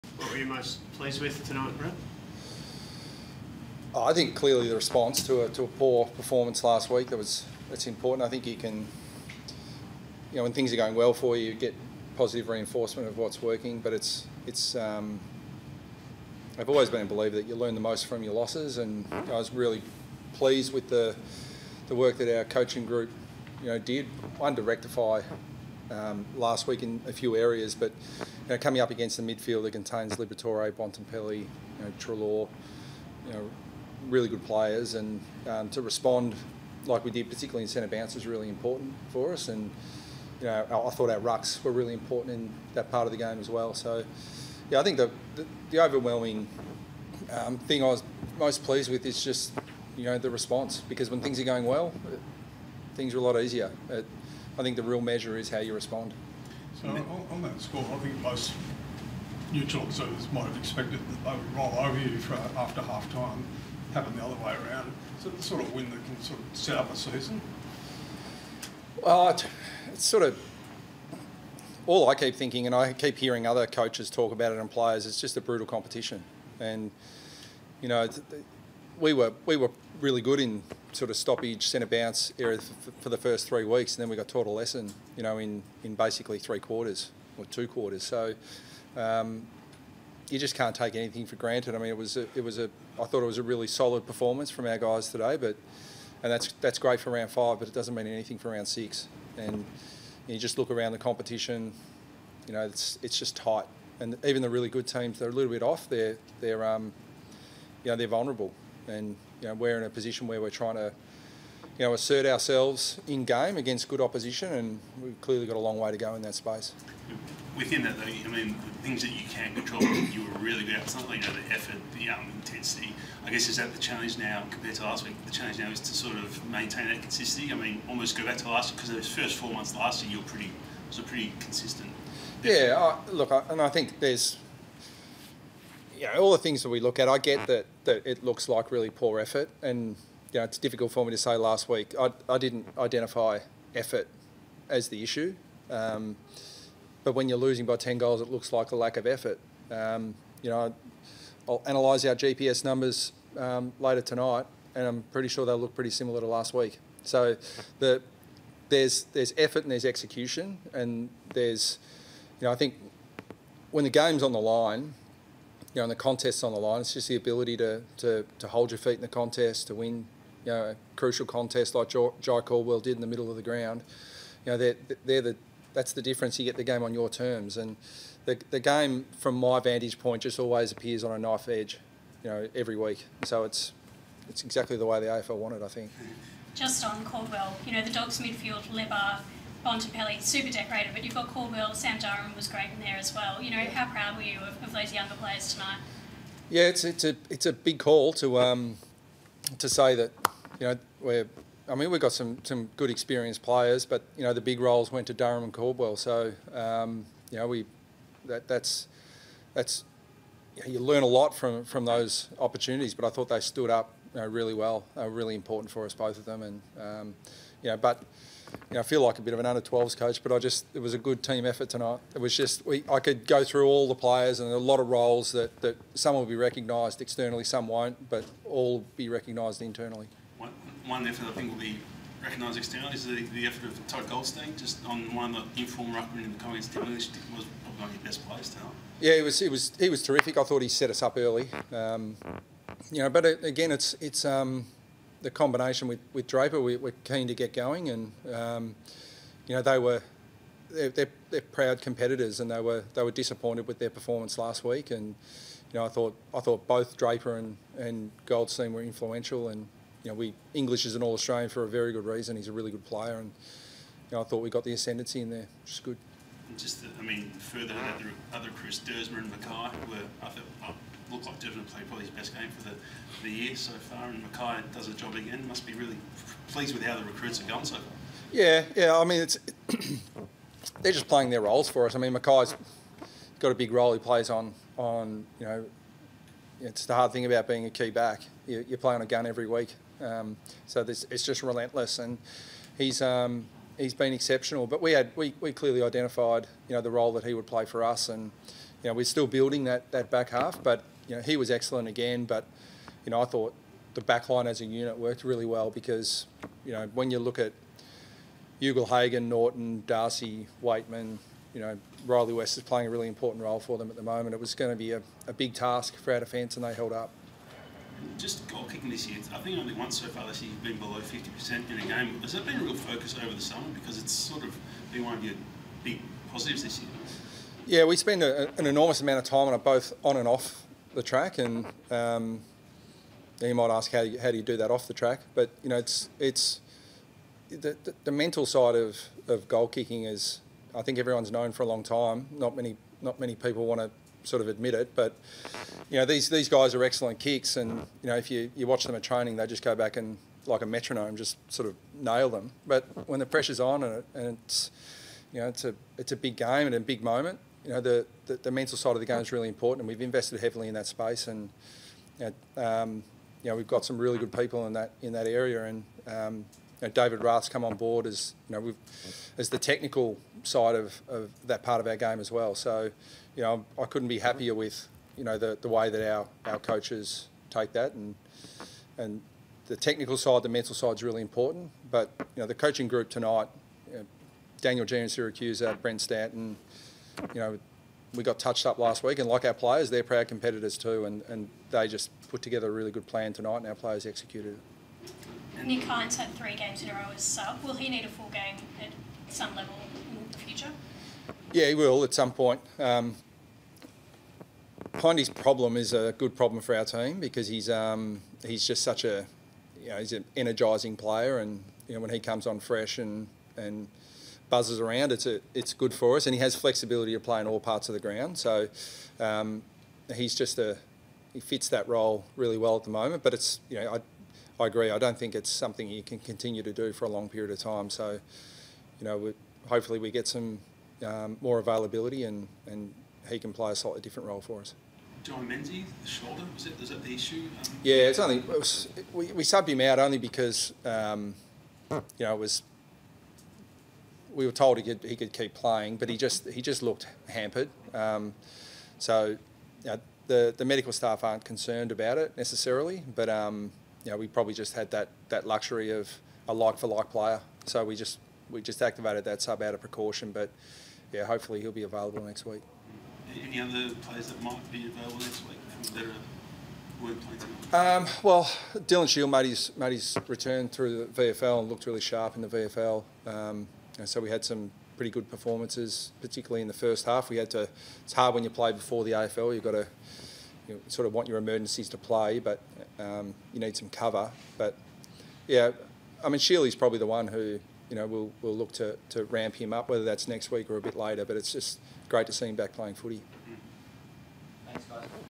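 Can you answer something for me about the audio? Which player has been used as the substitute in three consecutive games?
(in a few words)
Nick Hind.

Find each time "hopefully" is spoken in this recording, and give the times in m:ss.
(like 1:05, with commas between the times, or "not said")
7:09, 7:41.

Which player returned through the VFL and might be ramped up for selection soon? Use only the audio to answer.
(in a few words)
Dylan Shiel.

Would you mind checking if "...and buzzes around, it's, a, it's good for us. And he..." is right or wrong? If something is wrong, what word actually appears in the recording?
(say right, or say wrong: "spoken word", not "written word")
right.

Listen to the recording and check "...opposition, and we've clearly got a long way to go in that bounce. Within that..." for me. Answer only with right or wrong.
wrong.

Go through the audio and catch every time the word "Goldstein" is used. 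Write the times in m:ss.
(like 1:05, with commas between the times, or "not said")
3:54, 4:18.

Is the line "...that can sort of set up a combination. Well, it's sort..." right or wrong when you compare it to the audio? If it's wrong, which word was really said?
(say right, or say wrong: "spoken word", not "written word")
wrong: "season", not "combination".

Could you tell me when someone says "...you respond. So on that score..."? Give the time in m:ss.
0:55.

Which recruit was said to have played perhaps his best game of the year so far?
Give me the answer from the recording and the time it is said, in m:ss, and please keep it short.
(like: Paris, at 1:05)
Devon, at 4:31.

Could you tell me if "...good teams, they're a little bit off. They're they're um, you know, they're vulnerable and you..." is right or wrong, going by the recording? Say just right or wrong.
right.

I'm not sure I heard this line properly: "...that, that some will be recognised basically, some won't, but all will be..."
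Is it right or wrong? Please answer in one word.
wrong.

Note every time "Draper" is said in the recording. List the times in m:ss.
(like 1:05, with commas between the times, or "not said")
4:06, 4:16.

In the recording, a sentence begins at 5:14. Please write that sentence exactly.
It was going to be a, a big task for our defence, and they held up.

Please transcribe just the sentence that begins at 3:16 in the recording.
Yeah, it's it's a it's a big call to um, to say that you know we're.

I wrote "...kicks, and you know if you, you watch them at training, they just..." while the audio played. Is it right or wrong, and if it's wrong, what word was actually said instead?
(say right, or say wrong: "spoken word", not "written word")
right.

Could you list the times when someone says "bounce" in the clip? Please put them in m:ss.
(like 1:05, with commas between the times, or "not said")
0:37, 1:21.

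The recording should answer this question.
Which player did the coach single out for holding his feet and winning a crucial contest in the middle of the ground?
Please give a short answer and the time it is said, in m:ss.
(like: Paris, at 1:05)
Jye Caldwell, at 2:51.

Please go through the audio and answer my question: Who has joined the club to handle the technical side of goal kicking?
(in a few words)
David Rath.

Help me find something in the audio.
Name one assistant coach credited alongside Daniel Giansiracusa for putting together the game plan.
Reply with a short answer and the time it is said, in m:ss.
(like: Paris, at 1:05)
Brent Stanton, at 6:25.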